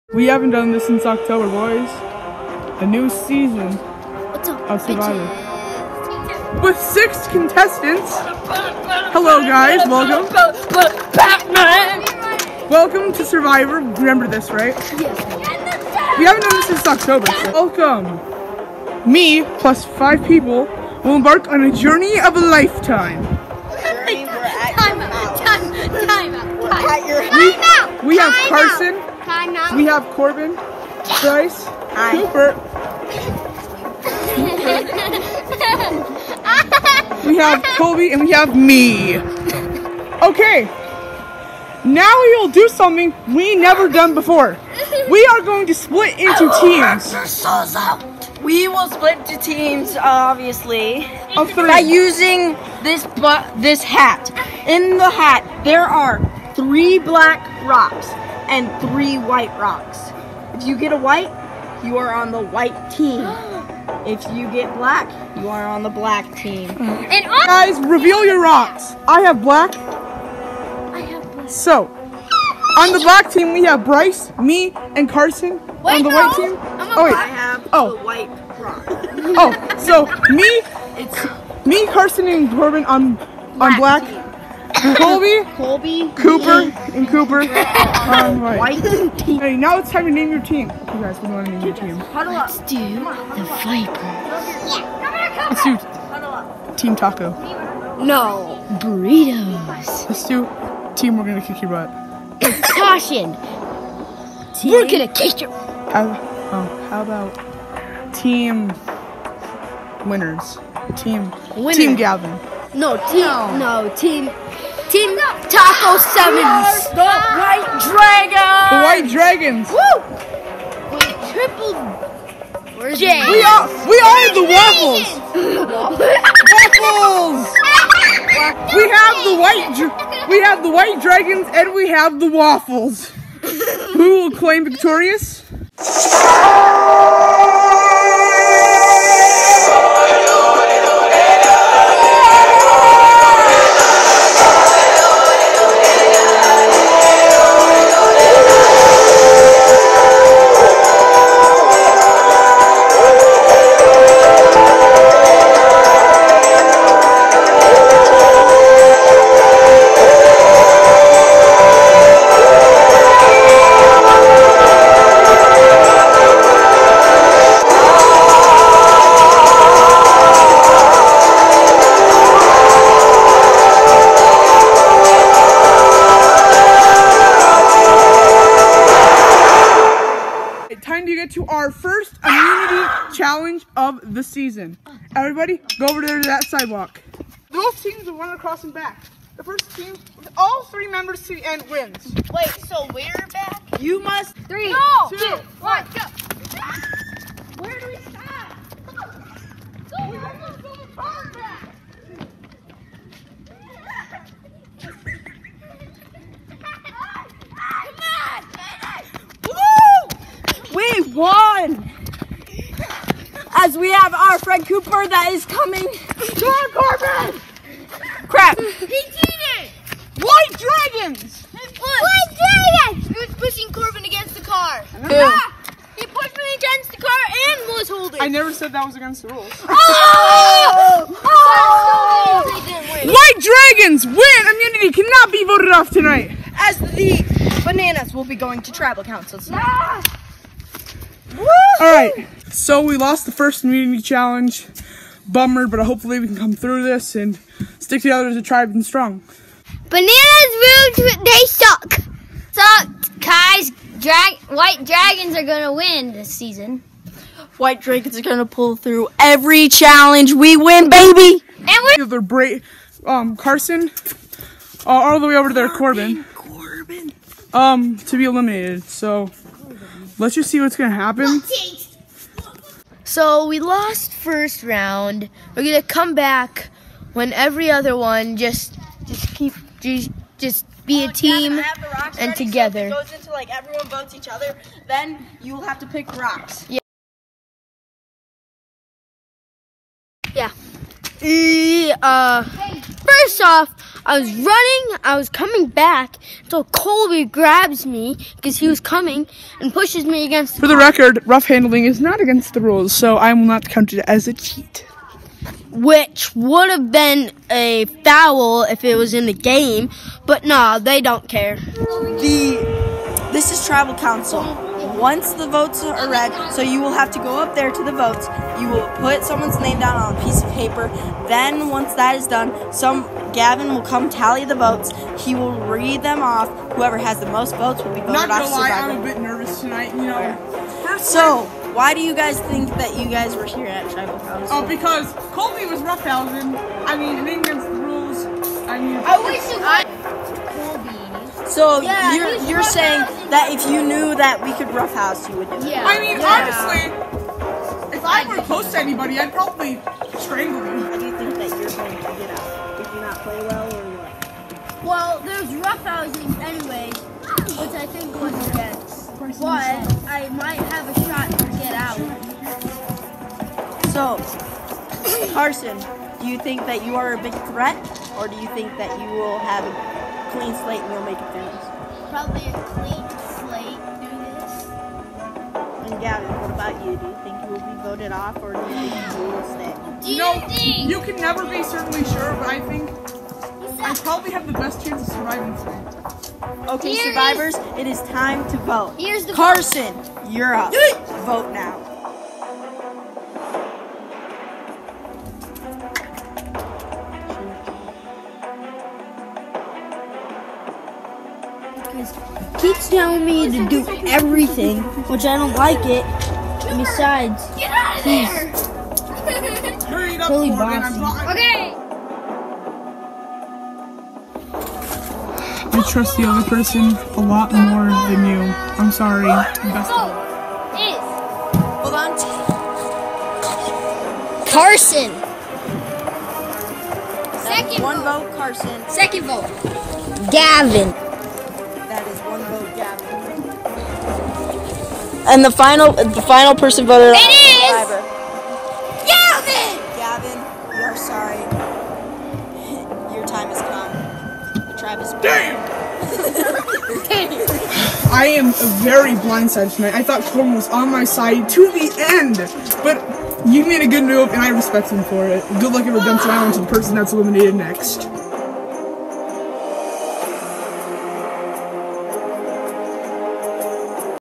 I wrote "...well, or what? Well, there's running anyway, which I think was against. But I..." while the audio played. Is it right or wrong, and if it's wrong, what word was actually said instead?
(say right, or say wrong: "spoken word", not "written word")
wrong: "roughhousing", not "running".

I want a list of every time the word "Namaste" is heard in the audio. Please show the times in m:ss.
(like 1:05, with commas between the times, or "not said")
not said.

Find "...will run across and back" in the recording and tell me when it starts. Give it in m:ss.
3:08.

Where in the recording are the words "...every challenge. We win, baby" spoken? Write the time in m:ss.
4:19.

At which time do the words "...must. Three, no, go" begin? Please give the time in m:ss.
3:14.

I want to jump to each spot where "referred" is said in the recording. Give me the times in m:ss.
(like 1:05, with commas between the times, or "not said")
not said.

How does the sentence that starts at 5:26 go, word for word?
Whoever has the most votes will be voted Not off.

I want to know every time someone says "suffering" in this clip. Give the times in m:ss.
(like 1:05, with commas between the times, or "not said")
not said.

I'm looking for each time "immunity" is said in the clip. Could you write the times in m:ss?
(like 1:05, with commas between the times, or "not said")
3:54, 4:03.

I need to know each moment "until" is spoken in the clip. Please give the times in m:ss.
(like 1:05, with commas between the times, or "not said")
4:56.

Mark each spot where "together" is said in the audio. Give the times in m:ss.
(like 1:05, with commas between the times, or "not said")
4:08, 4:42.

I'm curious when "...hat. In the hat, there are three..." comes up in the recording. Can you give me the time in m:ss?
0:53.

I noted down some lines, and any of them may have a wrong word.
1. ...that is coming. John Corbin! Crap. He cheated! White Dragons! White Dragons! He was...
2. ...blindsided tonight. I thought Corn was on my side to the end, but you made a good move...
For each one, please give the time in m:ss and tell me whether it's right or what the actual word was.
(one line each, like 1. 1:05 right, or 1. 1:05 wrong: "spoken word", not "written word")
1. 3:35 right
2. 7:29 right.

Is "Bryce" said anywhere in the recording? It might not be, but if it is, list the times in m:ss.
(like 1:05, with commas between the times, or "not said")
0:31, 1:13.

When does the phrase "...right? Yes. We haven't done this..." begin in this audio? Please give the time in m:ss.
0:14.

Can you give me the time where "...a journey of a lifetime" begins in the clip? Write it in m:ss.
0:21.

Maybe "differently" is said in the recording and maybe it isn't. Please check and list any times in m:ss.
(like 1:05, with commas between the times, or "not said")
not said.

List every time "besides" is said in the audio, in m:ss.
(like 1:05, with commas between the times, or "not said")
6:46.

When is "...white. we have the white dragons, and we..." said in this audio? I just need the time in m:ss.
2:09.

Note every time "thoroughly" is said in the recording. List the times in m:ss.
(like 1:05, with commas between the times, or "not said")
not said.